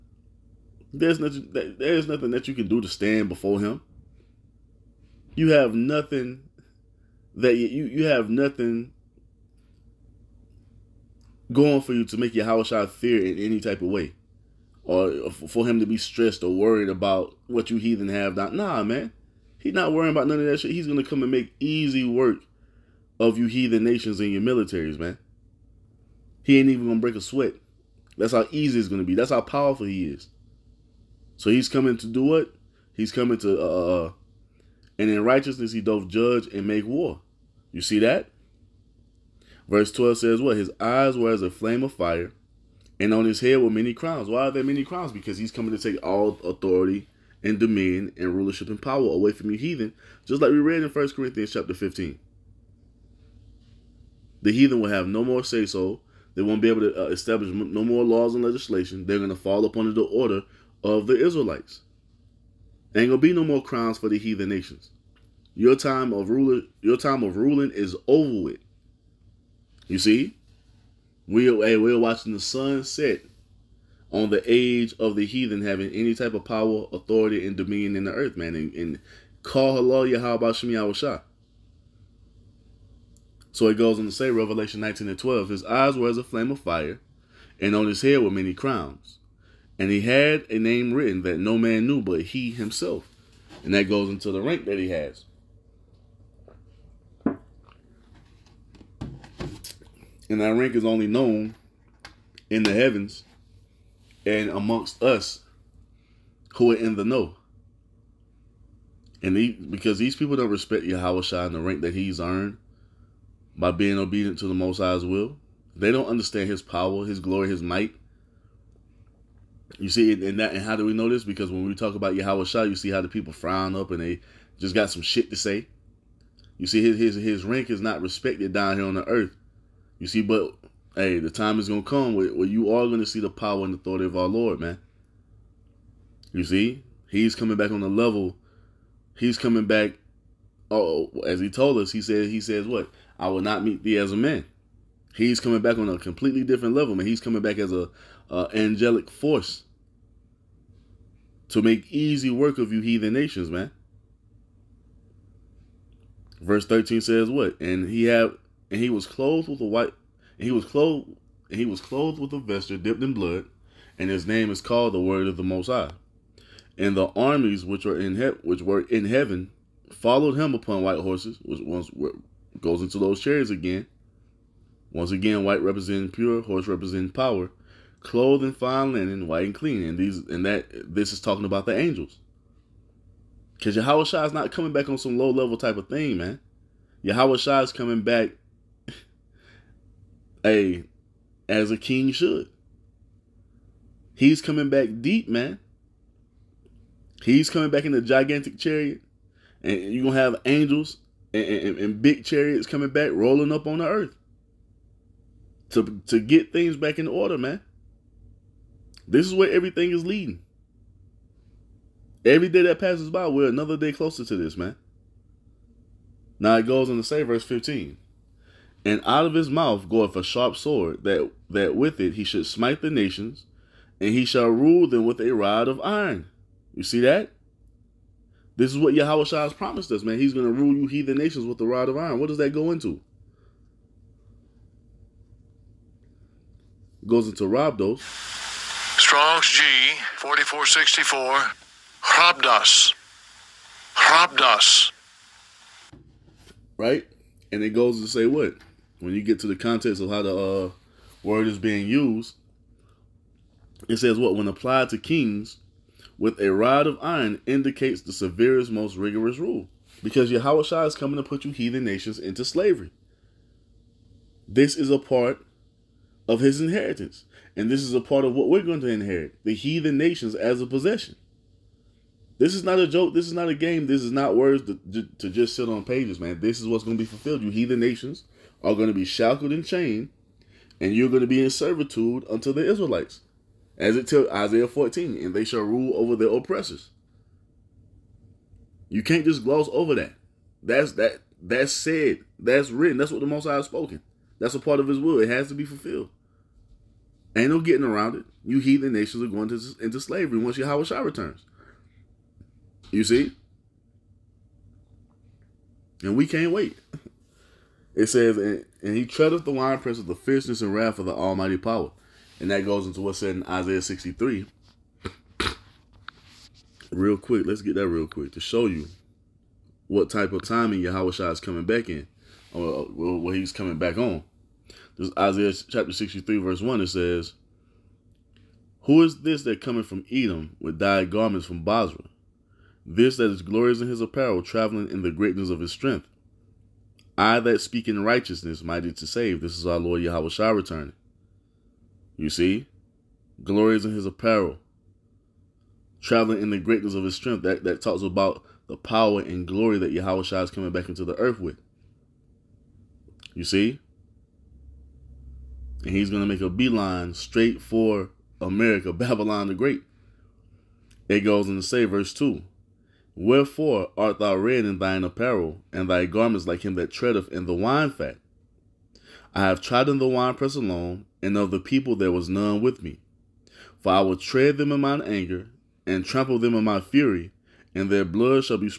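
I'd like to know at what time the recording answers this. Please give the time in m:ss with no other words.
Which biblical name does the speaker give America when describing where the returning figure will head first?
5:58.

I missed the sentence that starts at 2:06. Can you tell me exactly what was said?
You see, his his his rank is not respected down here on the earth.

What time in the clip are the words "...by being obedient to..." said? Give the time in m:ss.
1:53.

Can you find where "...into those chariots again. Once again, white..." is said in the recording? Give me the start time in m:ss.
2:52.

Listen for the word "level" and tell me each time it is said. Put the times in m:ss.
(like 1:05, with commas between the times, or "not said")
2:17, 2:26, 3:05.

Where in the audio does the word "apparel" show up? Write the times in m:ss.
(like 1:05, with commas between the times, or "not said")
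5:33, 5:44, 6:05.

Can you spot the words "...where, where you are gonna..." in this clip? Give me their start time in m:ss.
2:12.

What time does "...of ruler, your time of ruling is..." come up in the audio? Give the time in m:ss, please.
1:06.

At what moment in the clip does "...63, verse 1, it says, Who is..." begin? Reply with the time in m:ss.
5:25.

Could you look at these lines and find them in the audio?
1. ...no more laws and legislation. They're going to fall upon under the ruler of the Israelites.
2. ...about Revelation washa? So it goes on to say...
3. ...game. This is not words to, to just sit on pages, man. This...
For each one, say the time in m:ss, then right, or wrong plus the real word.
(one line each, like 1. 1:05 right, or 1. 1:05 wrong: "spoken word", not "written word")
1. 0:57 wrong: "order", not "ruler"
2. 1:20 wrong: "Shem", not "Revelation"
3. 4:33 right.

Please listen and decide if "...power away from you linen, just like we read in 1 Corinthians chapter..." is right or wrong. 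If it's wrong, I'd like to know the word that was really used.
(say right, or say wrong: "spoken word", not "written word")
wrong: "heathen", not "linen".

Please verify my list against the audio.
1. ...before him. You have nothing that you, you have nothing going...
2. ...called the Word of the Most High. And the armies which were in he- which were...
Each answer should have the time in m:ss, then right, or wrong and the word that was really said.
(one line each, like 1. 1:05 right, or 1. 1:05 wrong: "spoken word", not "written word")
1. 0:03 right
2. 2:44 right.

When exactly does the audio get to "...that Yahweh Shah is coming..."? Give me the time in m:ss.
5:49.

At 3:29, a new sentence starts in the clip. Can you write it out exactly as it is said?
This is where everything is leading.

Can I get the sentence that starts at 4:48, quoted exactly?
You can't just gloss over that.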